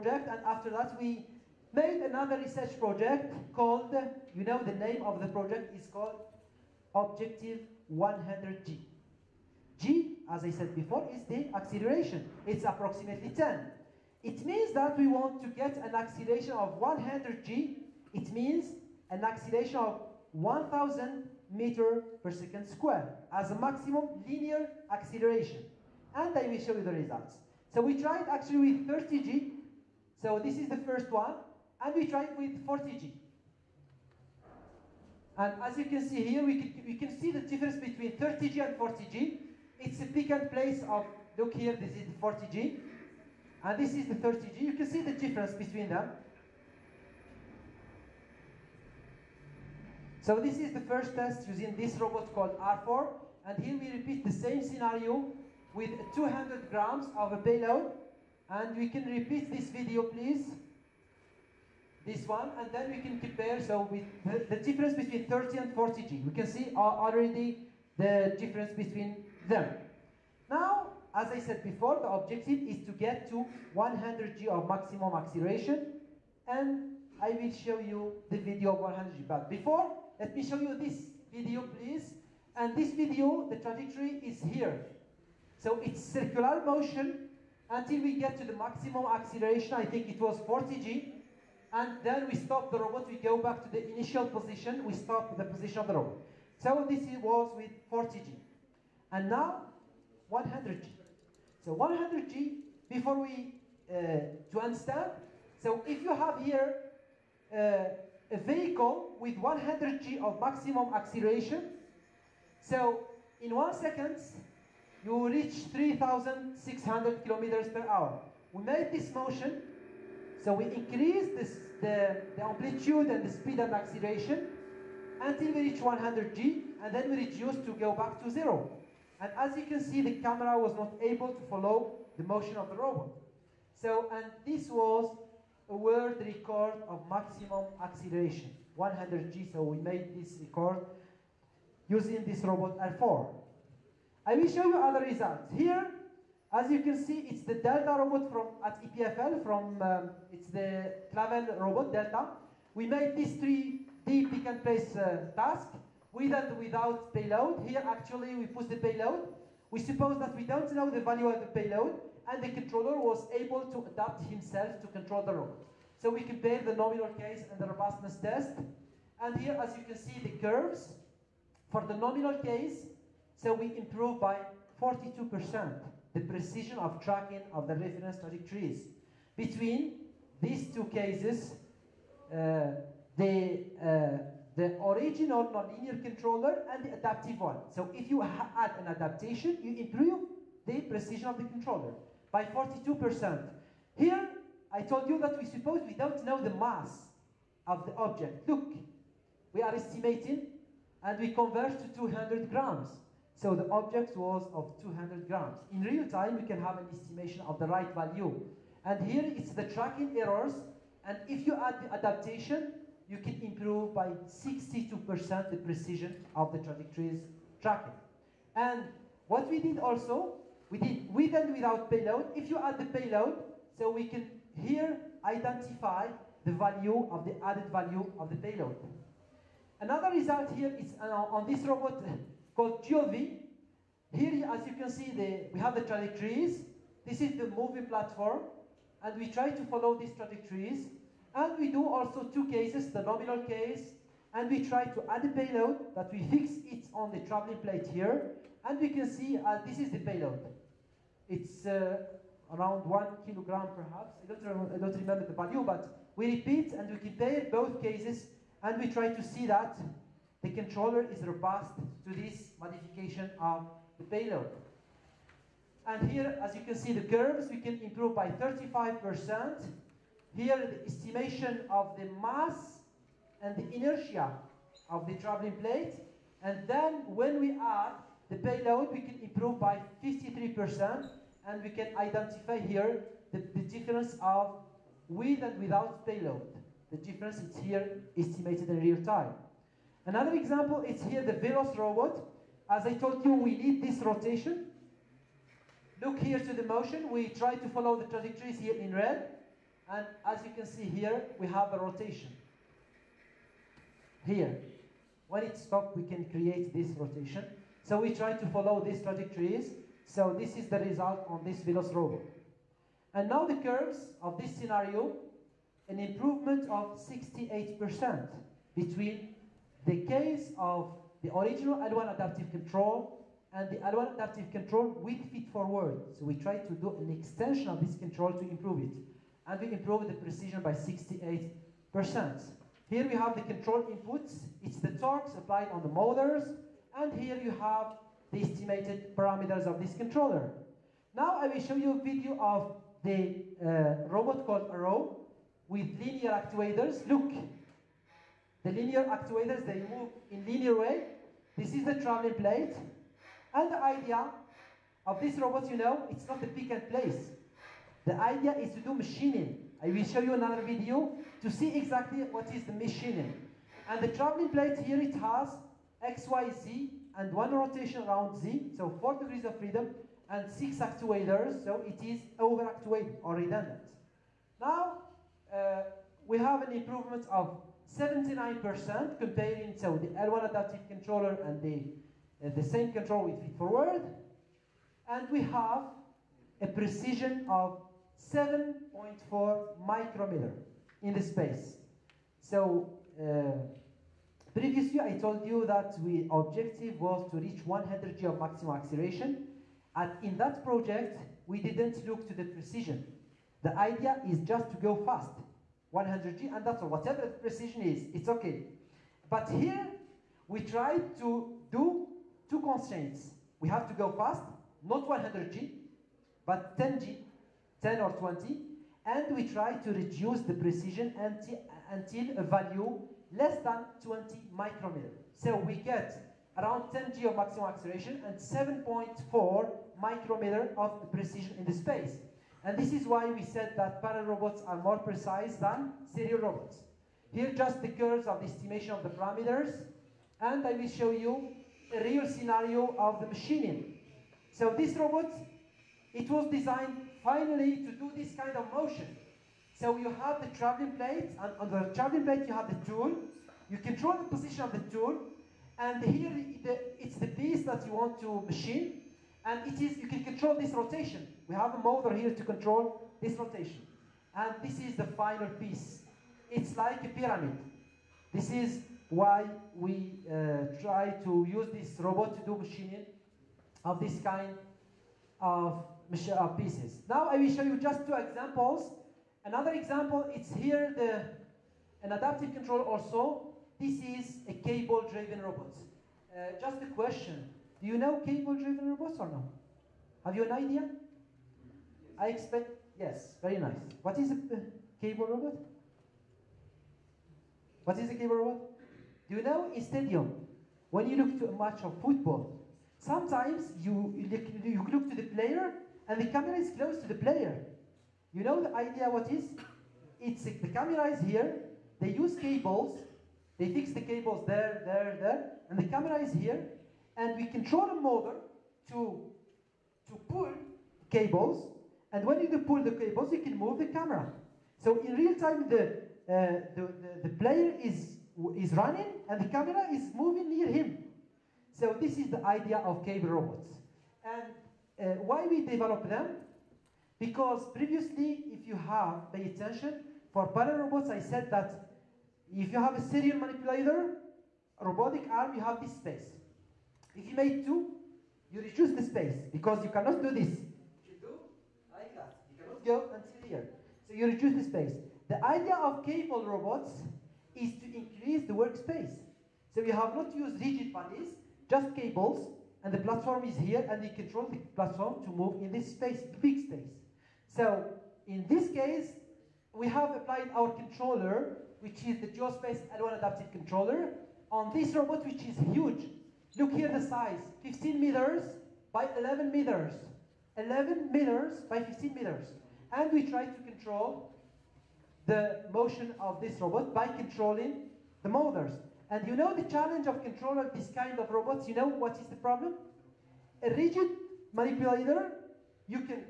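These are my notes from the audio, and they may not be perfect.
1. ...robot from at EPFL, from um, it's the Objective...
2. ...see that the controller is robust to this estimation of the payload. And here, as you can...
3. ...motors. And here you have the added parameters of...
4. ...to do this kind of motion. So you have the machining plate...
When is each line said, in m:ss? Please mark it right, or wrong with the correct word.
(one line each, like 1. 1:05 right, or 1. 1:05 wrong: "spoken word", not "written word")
1. 2:27 wrong: "Clavel", not "Objective"
2. 4:19 wrong: "modification", not "estimation"
3. 5:35 wrong: "estimated", not "added"
4. 7:27 wrong: "traveling", not "machining".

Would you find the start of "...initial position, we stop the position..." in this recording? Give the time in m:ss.
1:33.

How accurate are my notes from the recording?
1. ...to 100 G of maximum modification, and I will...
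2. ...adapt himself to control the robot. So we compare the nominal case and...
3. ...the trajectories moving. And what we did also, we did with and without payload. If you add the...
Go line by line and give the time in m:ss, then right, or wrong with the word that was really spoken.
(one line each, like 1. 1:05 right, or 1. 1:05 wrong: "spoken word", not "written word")
1. 1:13 wrong: "acceleration", not "modification"
2. 2:43 right
3. 3:36 wrong: "tracking", not "moving".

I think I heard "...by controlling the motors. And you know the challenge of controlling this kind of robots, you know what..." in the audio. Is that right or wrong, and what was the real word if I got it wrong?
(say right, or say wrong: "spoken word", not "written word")
right.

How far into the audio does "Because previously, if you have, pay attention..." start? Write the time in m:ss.
8:57.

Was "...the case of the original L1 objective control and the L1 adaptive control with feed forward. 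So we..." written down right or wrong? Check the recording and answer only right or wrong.
wrong.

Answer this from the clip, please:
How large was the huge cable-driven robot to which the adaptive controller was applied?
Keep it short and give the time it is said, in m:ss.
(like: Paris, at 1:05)
15 by 11 meters, at 9:37.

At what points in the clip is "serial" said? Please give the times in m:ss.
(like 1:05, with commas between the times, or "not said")
7:16, 9:03.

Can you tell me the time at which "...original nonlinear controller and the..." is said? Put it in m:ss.
3:04.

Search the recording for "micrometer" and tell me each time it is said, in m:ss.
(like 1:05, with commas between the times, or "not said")
6:29, 7:04, 7:10.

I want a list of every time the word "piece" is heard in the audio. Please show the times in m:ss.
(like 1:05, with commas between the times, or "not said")
7:37, 7:45, 7:56.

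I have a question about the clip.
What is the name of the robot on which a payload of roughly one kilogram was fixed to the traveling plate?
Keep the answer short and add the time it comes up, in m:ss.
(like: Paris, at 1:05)
DualV, at 3:52.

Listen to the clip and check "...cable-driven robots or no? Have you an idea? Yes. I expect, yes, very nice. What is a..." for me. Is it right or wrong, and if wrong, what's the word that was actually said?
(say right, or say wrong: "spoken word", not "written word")
right.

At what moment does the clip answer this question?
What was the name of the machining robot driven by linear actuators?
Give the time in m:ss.
5:44.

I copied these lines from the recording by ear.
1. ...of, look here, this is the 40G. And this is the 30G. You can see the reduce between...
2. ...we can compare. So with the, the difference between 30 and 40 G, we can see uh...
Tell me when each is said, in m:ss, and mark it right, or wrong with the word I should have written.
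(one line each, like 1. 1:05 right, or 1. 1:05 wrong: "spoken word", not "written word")
1. 0:40 wrong: "difference", not "reduce"
2. 1:02 right.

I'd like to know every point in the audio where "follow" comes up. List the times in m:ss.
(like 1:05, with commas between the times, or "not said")
2:11, 3:59, 4:57, 5:08.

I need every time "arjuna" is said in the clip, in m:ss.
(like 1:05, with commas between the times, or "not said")
not said.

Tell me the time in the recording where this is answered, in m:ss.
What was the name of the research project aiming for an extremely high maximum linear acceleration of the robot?
0:06.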